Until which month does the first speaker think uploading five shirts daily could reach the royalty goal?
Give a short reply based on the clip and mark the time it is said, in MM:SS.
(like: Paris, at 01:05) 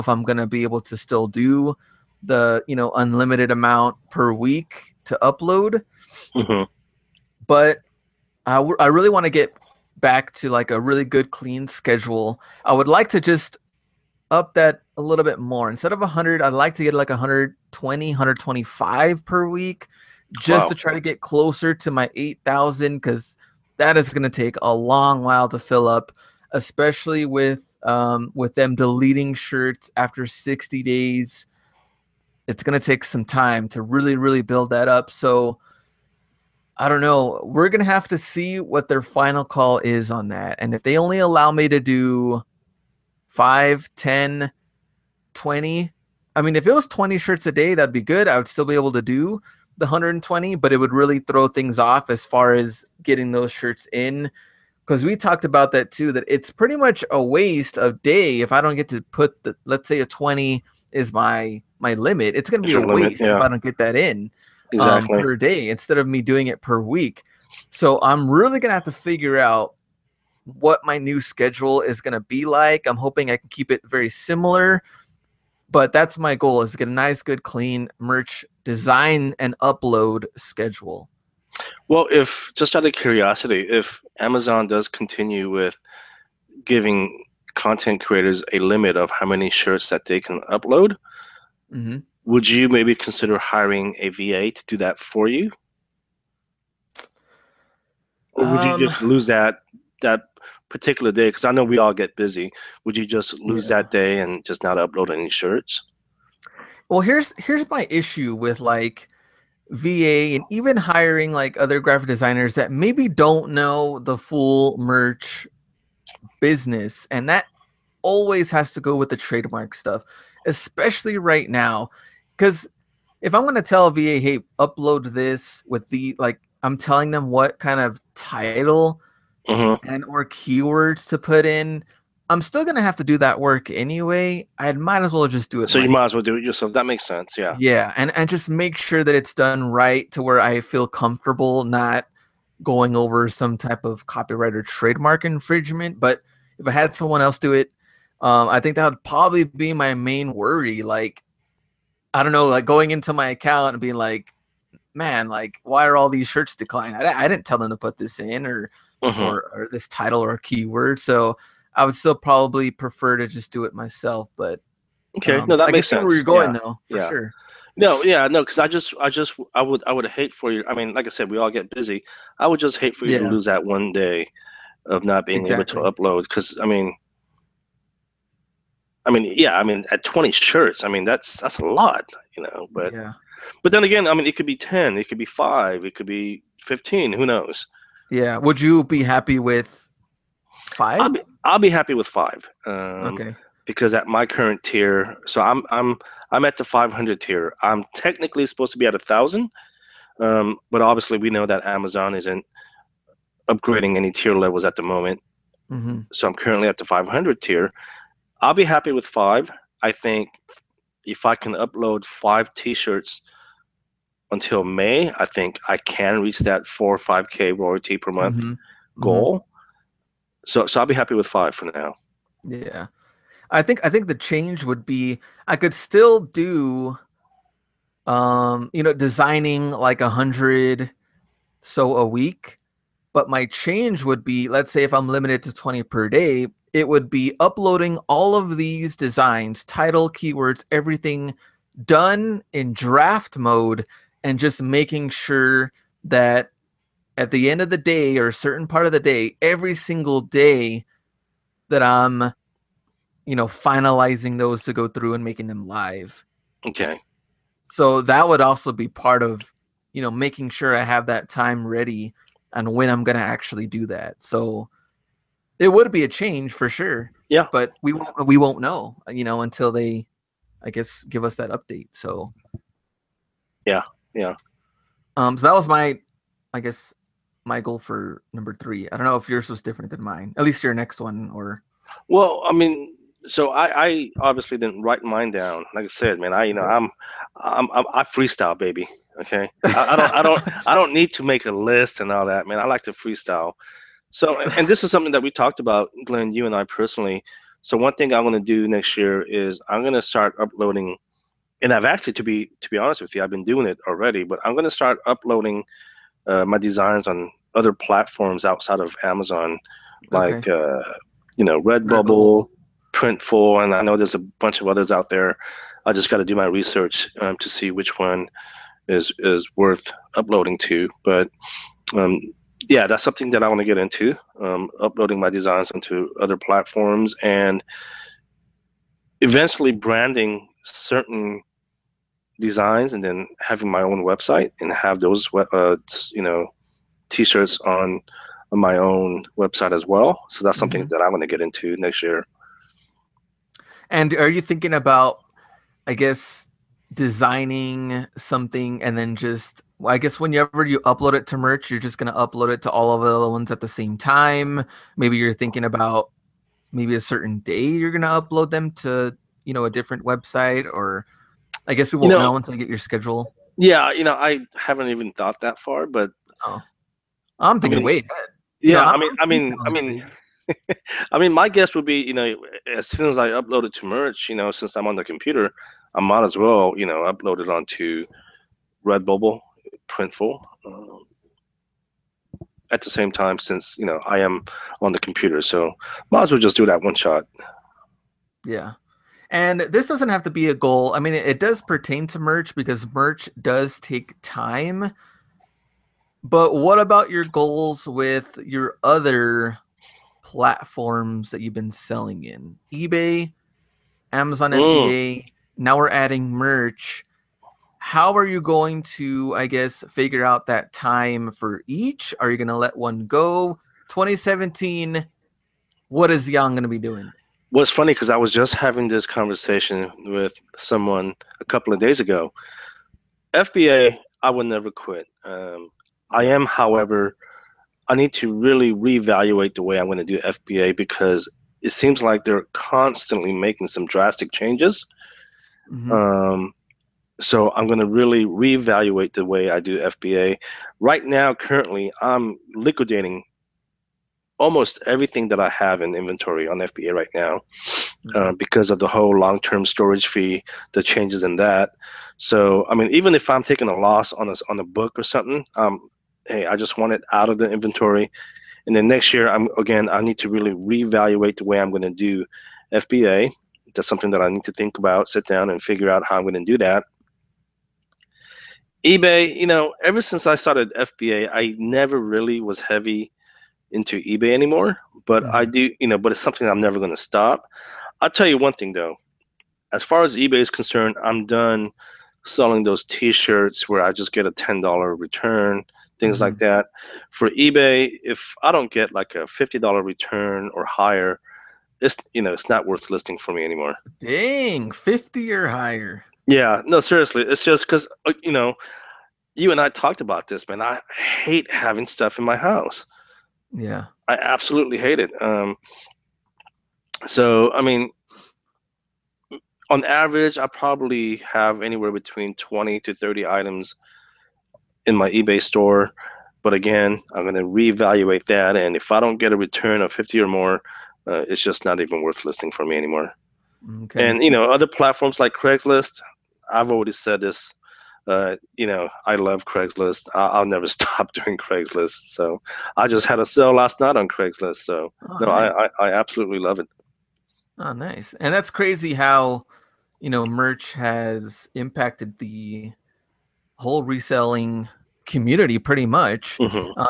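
May, at 03:34.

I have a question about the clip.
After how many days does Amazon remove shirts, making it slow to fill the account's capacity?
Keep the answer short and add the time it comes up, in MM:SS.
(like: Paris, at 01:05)
60 days, at 00:30.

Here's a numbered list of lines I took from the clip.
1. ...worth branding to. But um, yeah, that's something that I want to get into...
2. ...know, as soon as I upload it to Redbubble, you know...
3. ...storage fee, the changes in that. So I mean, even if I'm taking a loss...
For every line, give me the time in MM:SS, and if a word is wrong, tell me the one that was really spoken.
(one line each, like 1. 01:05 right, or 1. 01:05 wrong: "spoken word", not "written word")
1. 05:19 wrong: "uploading", not "branding"
2. 06:12 wrong: "Merch", not "Redbubble"
3. 07:29 right.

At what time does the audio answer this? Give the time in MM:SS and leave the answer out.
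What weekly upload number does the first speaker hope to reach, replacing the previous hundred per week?
00:17.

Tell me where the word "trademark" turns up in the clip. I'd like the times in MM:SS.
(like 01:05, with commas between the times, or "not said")
01:59, 02:24.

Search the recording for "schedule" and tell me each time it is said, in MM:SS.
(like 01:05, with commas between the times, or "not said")
00:11, 01:11, 01:20, 06:02.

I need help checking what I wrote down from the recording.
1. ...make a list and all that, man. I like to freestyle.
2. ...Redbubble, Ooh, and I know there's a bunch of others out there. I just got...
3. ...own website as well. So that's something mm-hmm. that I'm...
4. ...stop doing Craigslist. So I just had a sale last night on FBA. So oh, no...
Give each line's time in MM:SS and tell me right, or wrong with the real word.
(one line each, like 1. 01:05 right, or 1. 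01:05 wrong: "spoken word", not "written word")
1. 04:51 right
2. 05:11 wrong: "Printful", not "Ooh"
3. 05:38 right
4. 08:50 wrong: "Craigslist", not "FBA".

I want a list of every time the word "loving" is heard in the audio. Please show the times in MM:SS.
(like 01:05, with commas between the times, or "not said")
not said.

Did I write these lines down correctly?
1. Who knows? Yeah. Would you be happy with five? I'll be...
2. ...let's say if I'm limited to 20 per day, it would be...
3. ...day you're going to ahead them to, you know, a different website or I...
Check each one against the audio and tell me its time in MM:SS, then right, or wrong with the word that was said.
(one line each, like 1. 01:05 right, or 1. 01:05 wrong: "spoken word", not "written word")
1. 03:07 right
2. 03:54 right
3. 05:57 wrong: "upload", not "ahead".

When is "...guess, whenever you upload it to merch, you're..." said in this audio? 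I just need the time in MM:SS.
05:49.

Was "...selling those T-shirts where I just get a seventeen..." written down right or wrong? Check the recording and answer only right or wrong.
wrong.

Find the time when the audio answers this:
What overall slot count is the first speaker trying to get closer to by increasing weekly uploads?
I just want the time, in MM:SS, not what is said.
00:22.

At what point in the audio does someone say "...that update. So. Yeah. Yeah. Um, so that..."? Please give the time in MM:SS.
04:31.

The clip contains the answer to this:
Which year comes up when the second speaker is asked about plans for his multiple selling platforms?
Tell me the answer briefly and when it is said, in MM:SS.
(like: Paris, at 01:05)
2017, at 06:53.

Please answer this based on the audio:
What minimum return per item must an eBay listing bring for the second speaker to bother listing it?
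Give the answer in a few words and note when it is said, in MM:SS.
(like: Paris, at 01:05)
$50, at 08:09.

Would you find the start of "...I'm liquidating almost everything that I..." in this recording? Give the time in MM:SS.
07:22.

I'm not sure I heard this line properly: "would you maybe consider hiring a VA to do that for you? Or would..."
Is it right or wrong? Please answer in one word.
right.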